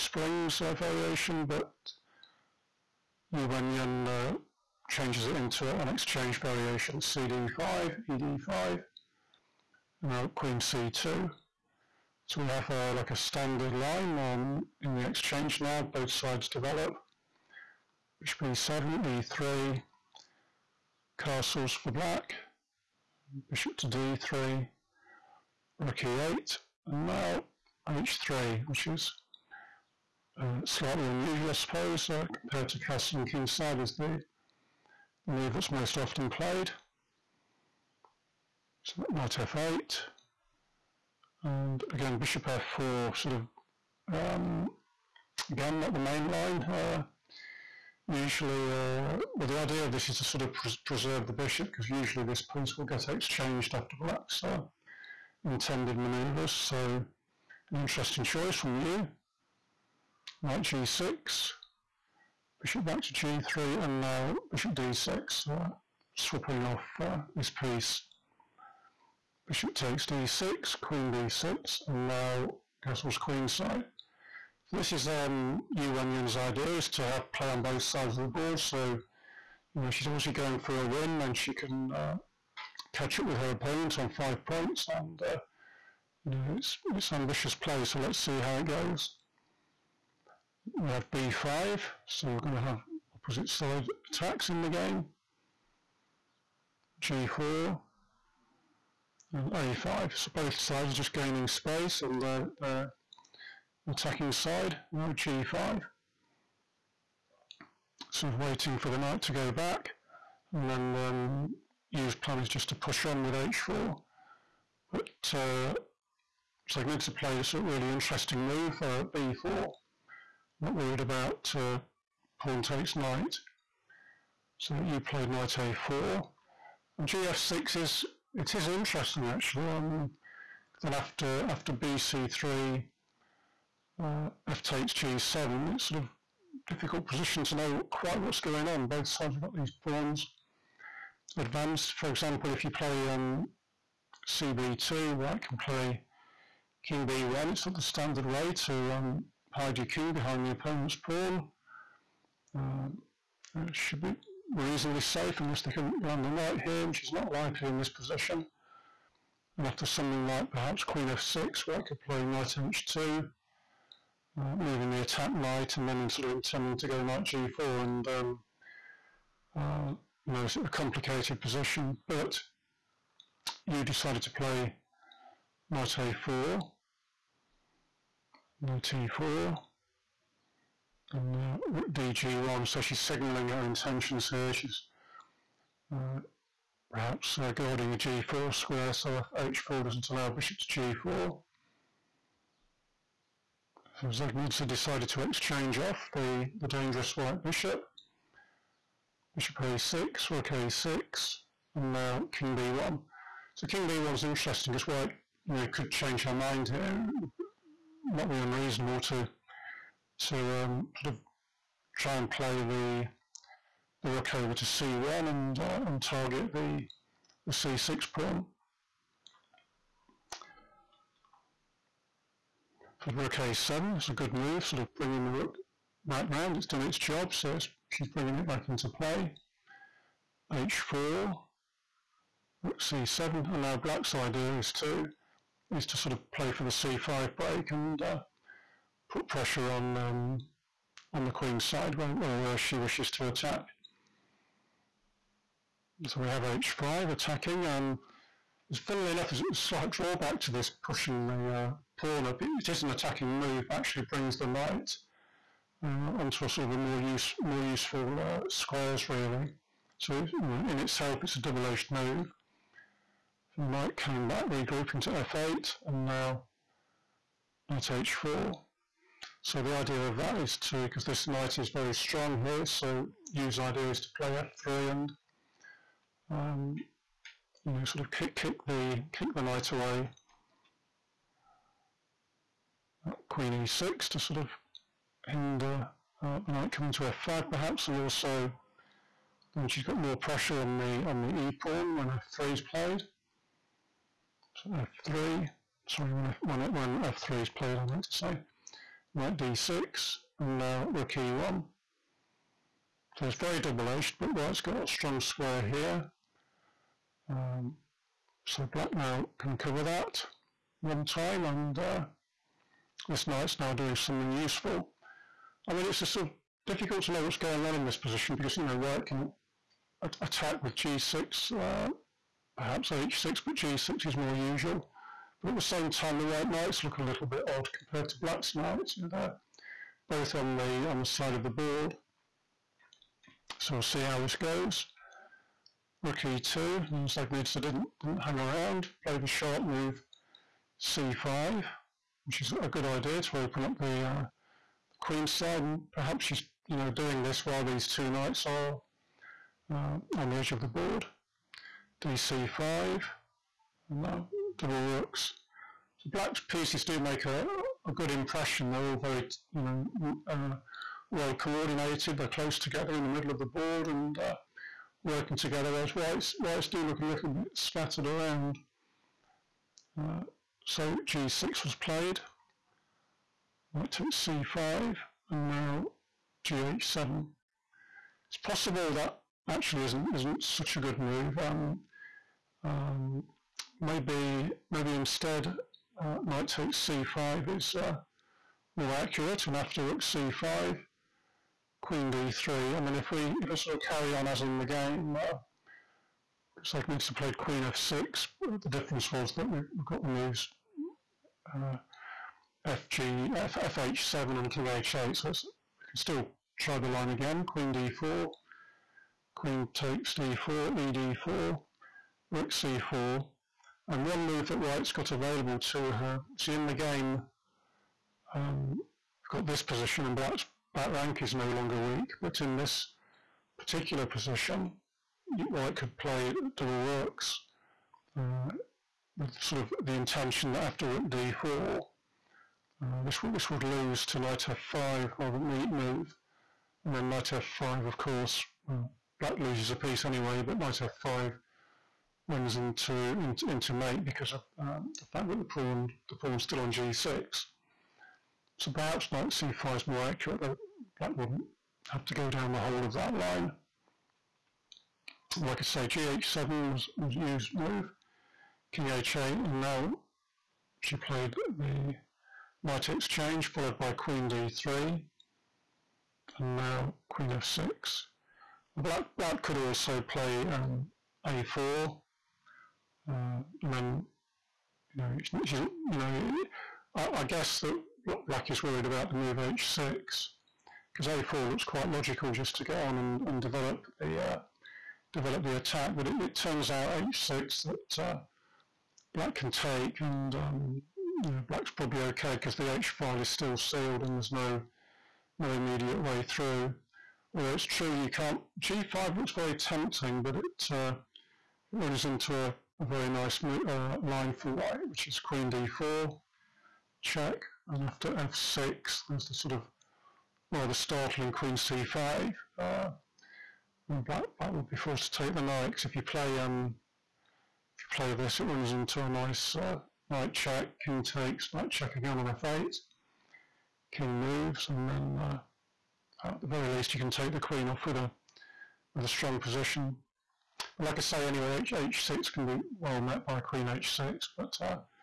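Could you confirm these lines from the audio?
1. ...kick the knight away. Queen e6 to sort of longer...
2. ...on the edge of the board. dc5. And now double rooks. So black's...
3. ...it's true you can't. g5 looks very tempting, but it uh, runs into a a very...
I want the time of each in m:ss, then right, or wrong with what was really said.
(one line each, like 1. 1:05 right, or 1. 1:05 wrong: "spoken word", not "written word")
1. 4:39 wrong: "hinder", not "longer"
2. 5:50 right
3. 8:17 right.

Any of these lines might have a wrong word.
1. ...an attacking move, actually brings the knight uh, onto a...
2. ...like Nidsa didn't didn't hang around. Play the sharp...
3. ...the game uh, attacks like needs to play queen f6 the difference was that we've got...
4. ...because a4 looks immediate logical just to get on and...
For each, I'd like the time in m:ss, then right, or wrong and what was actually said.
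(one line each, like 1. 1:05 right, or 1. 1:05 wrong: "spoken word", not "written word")
1. 4:12 right
2. 5:37 right
3. 6:34 wrong: "looks", not "attacks"
4. 7:59 wrong: "quite", not "immediate".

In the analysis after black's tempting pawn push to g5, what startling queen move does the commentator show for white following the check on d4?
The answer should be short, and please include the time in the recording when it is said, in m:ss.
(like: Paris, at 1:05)
Queen c5, at 8:31.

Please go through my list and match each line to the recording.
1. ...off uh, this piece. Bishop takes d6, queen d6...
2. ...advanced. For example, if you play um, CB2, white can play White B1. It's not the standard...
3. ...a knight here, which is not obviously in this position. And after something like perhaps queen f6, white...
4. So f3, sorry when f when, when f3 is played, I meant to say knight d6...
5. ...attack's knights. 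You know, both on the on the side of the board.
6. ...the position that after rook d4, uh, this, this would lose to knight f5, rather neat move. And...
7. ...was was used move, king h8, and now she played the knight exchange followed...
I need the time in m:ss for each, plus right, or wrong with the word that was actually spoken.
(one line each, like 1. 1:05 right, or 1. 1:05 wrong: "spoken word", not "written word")
1. 1:06 right
2. 2:21 wrong: "King", not "White"
3. 2:36 wrong: "likely", not "obviously"
4. 4:54 right
5. 5:28 wrong: "black", not "attack"
6. 7:09 wrong: "intention", not "position"
7. 7:36 right.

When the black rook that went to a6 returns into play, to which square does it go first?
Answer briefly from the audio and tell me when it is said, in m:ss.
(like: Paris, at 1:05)
a7, at 3:43.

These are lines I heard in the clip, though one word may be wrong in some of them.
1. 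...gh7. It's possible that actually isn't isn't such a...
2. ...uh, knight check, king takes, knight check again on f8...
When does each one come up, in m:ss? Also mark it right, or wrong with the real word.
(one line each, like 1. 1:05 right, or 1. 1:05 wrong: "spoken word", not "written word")
1. 6:16 right
2. 8:39 right.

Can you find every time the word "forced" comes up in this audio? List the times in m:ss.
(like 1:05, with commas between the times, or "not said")
8:34.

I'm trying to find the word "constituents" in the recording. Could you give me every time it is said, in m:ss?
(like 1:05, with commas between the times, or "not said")
not said.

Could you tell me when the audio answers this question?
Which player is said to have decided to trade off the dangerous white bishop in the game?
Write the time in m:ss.
3:14.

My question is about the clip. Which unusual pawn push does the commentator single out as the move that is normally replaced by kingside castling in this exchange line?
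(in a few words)
h3.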